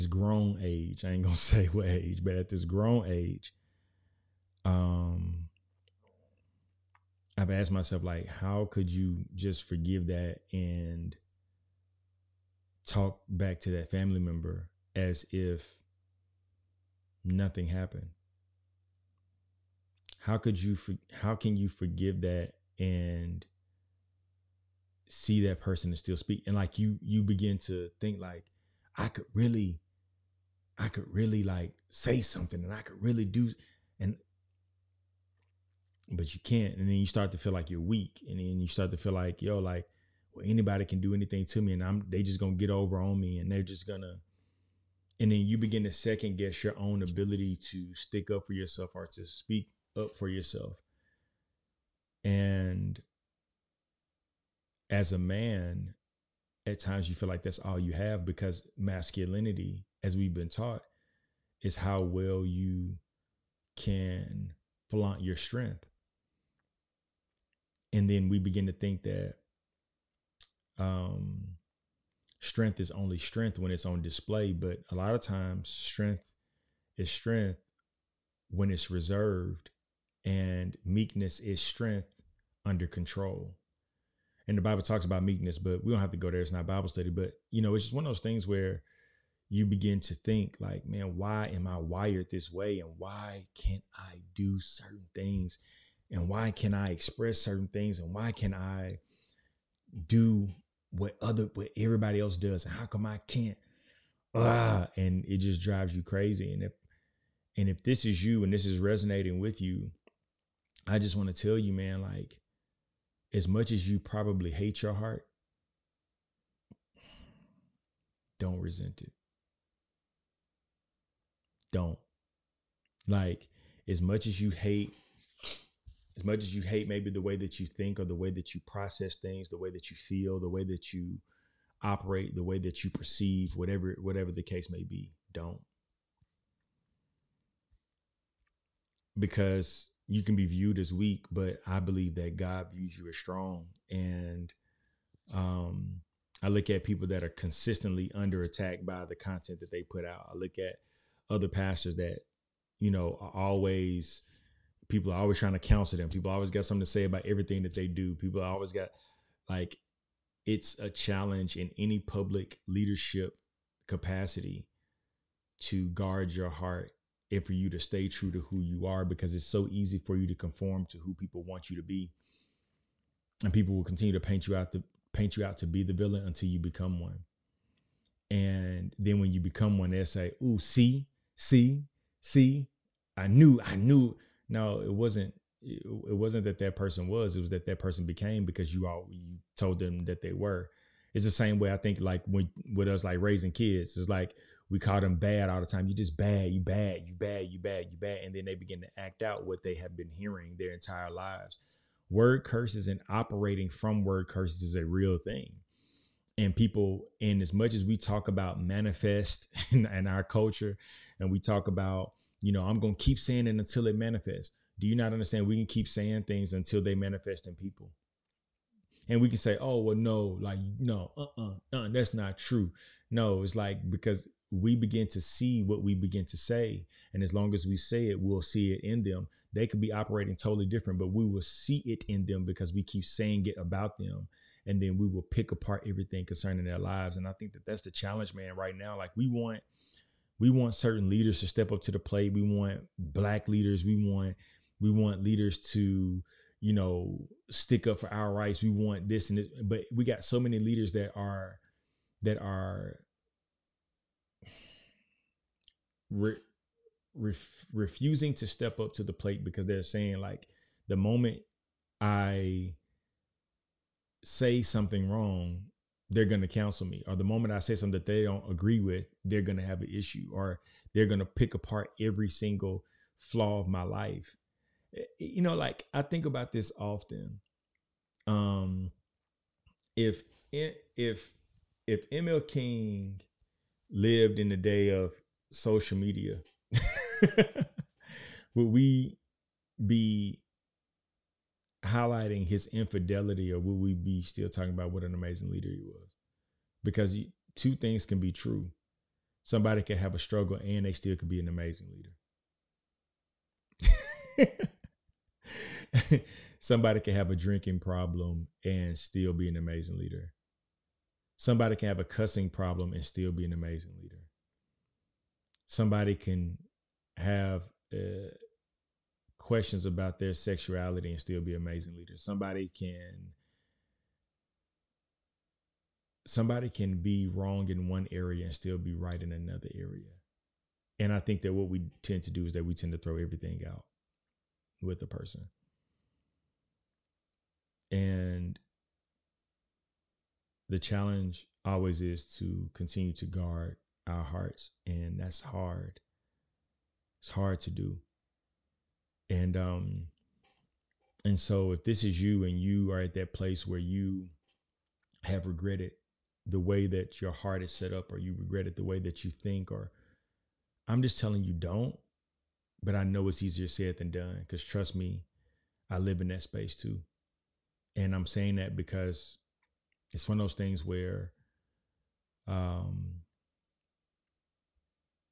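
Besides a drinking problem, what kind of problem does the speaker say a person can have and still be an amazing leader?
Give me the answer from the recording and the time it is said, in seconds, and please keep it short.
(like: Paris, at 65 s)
cussing problem, at 312 s.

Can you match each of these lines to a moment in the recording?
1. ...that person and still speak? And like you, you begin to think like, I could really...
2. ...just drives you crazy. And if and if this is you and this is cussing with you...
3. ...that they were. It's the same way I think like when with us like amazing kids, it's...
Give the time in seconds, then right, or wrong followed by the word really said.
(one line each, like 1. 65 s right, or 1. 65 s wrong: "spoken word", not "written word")
1. 25 s right
2. 105 s wrong: "resonating", not "cussing"
3. 190 s wrong: "raising", not "amazing".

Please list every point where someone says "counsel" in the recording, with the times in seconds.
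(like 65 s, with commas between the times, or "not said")
155 s, 266 s.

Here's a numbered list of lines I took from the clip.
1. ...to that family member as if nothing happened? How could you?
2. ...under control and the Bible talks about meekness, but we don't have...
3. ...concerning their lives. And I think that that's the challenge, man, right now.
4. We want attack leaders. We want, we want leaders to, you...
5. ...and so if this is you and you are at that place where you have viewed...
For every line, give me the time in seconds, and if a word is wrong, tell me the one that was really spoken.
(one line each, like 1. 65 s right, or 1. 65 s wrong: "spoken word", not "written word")
1. 13 s right
2. 82 s right
3. 236 s right
4. 242 s wrong: "black", not "attack"
5. 351 s wrong: "regretted", not "viewed".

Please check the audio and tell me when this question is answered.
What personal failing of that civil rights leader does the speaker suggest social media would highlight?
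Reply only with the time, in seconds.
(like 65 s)
292 s.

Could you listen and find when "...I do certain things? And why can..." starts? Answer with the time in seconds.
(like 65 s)
93 s.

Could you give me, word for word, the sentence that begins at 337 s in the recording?
And the challenge always is to continue to guard our hearts.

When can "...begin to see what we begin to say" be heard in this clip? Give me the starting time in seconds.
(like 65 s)
224 s.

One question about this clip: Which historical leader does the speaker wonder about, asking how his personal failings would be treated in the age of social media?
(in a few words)
ML King.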